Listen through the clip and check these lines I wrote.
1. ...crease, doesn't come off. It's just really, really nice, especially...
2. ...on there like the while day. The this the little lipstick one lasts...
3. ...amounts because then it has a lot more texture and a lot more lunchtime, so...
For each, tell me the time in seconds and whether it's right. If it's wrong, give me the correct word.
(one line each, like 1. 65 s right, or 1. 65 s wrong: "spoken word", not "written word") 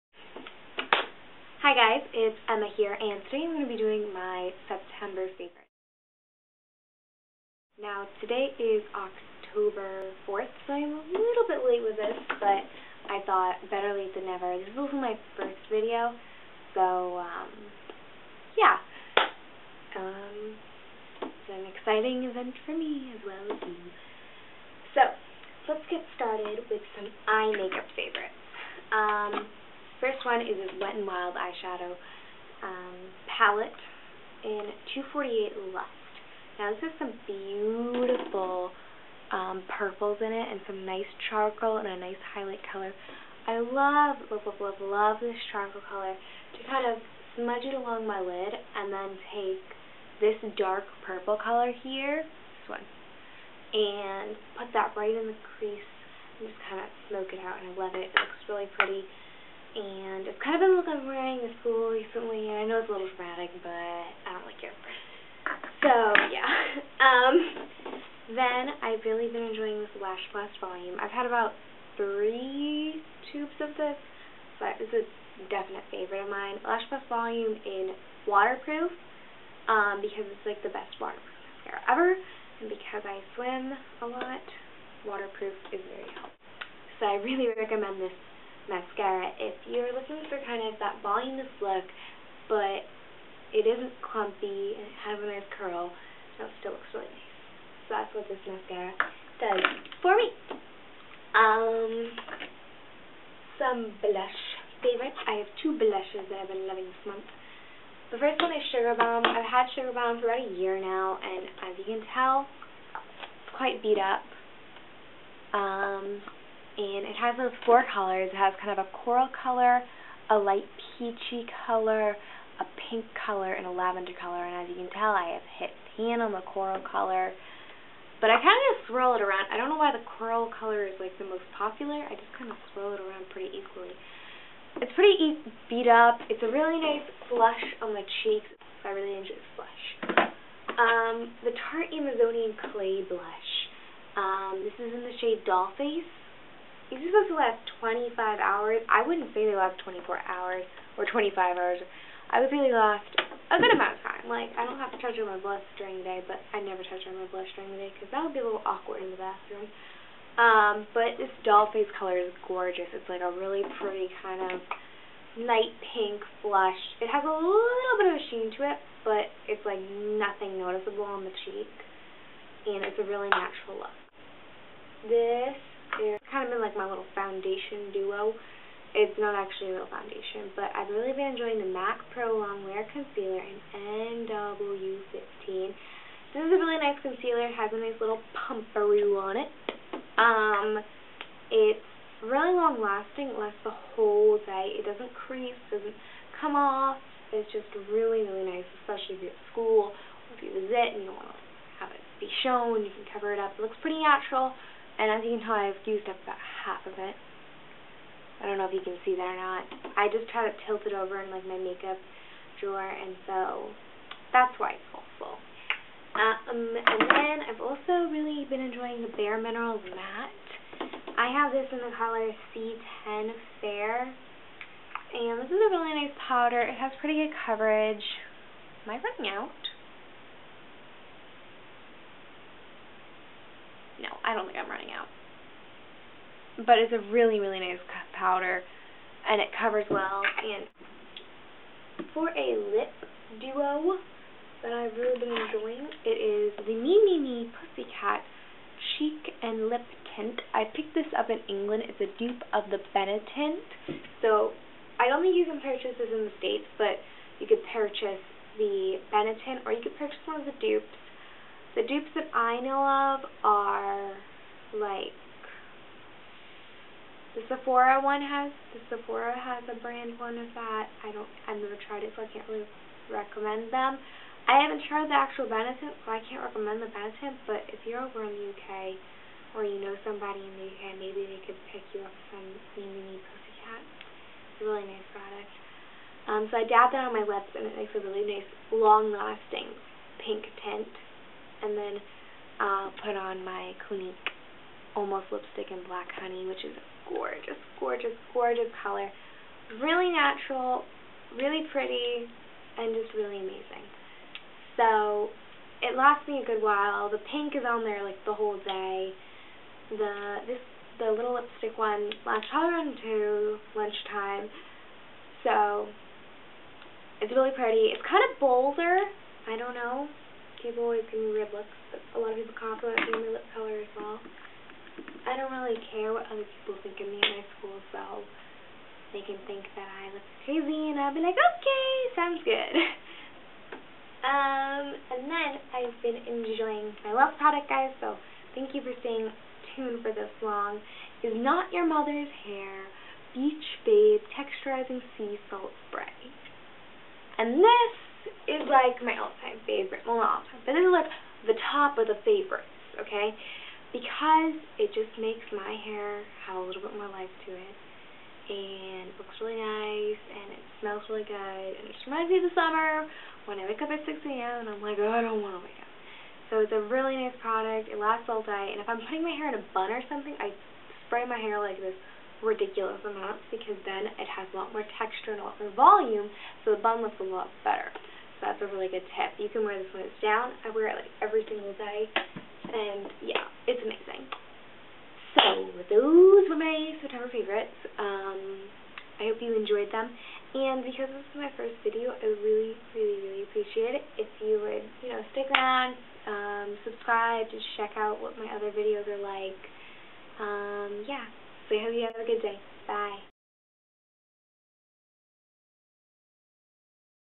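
1. 195 s right
2. 307 s wrong: "whole", not "while"
3. 373 s wrong: "volume", not "lunchtime".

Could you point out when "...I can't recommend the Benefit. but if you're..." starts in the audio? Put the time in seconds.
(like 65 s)
276 s.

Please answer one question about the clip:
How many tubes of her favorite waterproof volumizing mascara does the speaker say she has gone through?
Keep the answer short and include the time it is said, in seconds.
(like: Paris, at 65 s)
3, at 71 s.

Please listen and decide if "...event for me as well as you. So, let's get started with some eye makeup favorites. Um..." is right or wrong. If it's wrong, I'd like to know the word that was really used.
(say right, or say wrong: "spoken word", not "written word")
right.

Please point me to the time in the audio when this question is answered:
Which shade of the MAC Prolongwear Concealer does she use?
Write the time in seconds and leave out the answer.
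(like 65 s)
184 s.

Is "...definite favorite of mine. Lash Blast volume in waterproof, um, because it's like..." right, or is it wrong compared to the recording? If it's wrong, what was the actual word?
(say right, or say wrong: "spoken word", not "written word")
right.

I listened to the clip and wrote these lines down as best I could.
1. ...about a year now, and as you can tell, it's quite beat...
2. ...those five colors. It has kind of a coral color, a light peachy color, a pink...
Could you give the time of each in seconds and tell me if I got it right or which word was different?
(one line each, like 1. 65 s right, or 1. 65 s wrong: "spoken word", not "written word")
1. 110 s right
2. 117 s wrong: "four", not "five".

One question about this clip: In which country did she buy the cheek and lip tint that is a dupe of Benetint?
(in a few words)
England.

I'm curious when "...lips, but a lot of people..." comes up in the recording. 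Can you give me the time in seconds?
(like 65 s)
321 s.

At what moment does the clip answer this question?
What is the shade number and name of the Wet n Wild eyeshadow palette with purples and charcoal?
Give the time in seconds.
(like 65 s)
34 s.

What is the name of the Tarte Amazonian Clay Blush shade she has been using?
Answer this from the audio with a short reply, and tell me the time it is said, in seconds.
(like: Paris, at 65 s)
Dollface, at 145 s.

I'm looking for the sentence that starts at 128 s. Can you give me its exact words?
But I kind of just swirl it around.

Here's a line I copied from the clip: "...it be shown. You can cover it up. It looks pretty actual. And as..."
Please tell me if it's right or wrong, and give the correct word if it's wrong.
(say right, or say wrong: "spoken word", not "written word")
wrong: "natural", not "actual".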